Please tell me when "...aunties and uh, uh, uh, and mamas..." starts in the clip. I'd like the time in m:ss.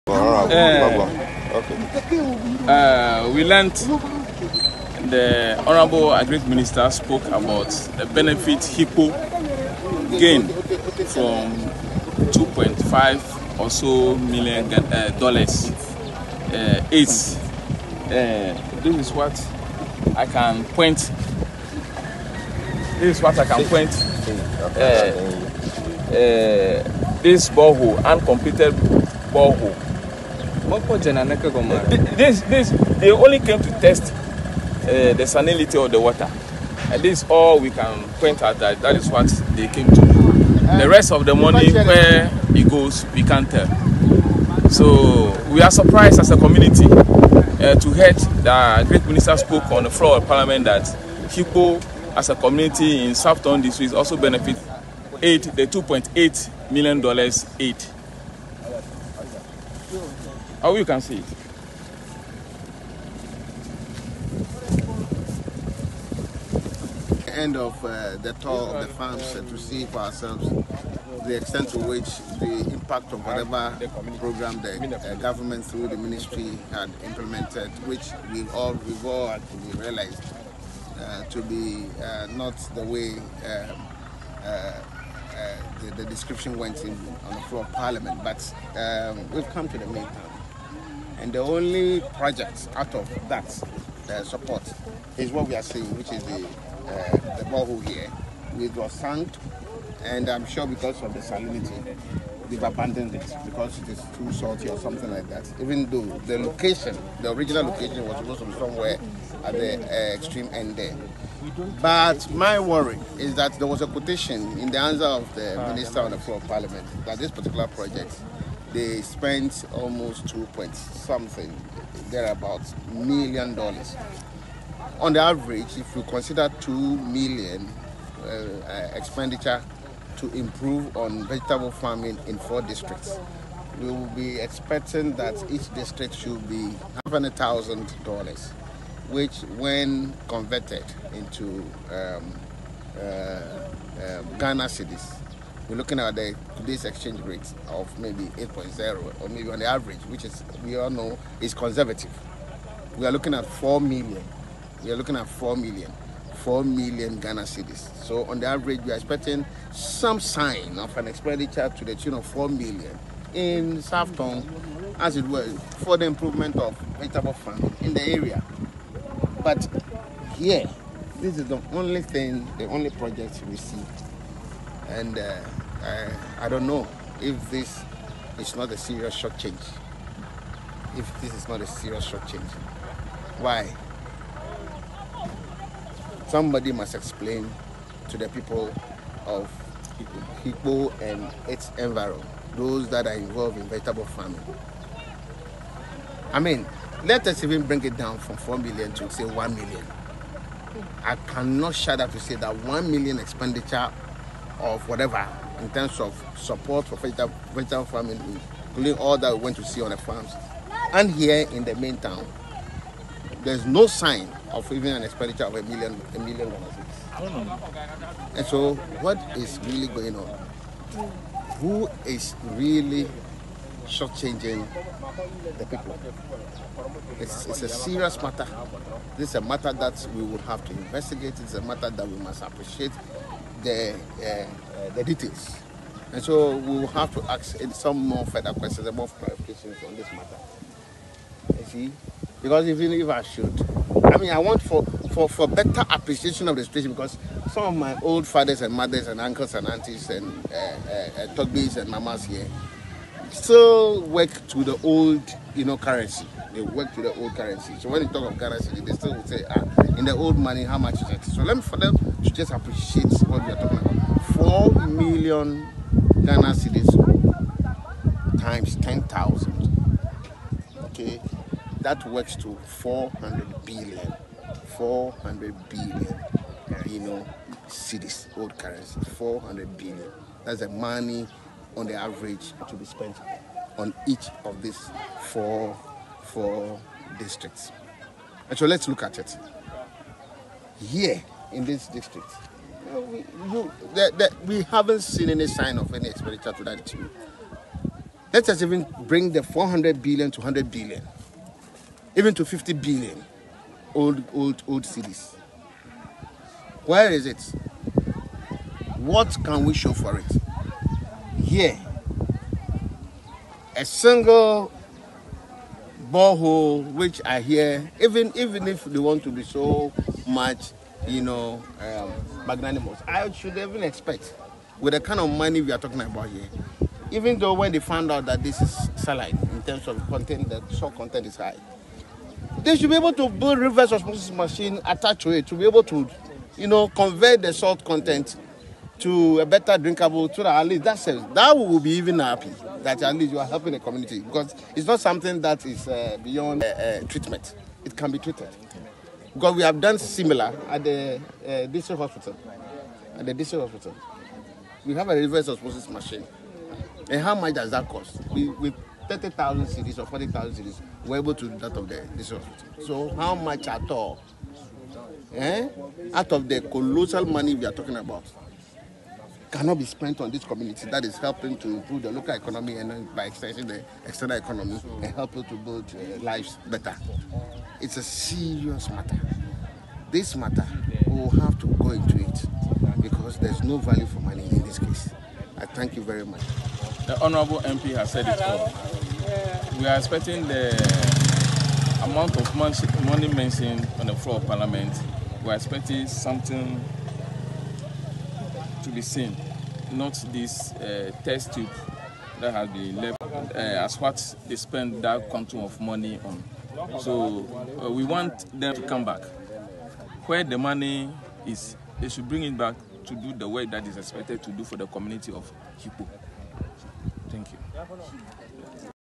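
4:09.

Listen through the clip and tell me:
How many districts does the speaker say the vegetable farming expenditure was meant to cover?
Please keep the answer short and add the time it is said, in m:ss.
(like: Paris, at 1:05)
4, at 2:12.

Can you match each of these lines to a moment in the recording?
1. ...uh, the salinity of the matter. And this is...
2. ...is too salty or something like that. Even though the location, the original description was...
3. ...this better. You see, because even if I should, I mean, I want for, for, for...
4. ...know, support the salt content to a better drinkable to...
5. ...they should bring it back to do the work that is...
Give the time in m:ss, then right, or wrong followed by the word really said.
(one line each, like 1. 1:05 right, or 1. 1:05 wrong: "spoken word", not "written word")
1. 0:34 wrong: "water", not "matter"
2. 1:43 wrong: "location", not "description"
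3. 3:59 wrong: "matter", not "better"
4. 5:36 wrong: "convert", not "support"
5. 6:51 right.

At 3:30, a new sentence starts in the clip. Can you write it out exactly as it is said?
And here in the main town, there's no sign of even an expenditure of a million, a million dollars.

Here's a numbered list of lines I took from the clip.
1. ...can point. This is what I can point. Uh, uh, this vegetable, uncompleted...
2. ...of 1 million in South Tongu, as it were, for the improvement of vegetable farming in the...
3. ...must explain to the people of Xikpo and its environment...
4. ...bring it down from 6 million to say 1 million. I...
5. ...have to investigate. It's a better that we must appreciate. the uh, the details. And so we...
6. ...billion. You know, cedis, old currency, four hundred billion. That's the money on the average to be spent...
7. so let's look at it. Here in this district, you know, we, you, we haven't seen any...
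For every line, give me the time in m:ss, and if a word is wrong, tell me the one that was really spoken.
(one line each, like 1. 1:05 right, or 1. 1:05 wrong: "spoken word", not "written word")
1. 0:20 wrong: "borehole", not "vegetable"
2. 2:42 wrong: "4", not "1"
3. 3:06 right
4. 3:17 wrong: "4", not "6"
5. 3:50 wrong: "matter", not "better"
6. 4:35 right
7. 4:48 right.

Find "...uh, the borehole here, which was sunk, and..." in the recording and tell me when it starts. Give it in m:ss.
1:36.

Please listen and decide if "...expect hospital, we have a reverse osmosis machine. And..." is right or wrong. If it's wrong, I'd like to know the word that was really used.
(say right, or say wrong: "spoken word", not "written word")
wrong: "district", not "expect".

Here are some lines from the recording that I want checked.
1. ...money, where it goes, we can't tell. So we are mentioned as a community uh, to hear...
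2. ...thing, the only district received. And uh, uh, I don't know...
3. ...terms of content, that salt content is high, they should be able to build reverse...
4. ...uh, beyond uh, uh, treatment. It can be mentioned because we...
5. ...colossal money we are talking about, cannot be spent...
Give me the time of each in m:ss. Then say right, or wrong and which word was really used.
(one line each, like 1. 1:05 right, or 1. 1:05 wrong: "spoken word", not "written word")
1. 0:41 wrong: "surprised", not "mentioned"
2. 2:52 wrong: "project", not "district"
3. 5:29 right
4. 5:45 wrong: "treated", not "mentioned"
5. 6:06 right.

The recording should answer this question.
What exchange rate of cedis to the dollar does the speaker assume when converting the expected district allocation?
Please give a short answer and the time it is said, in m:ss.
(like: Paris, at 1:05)
8.0, at 2:28.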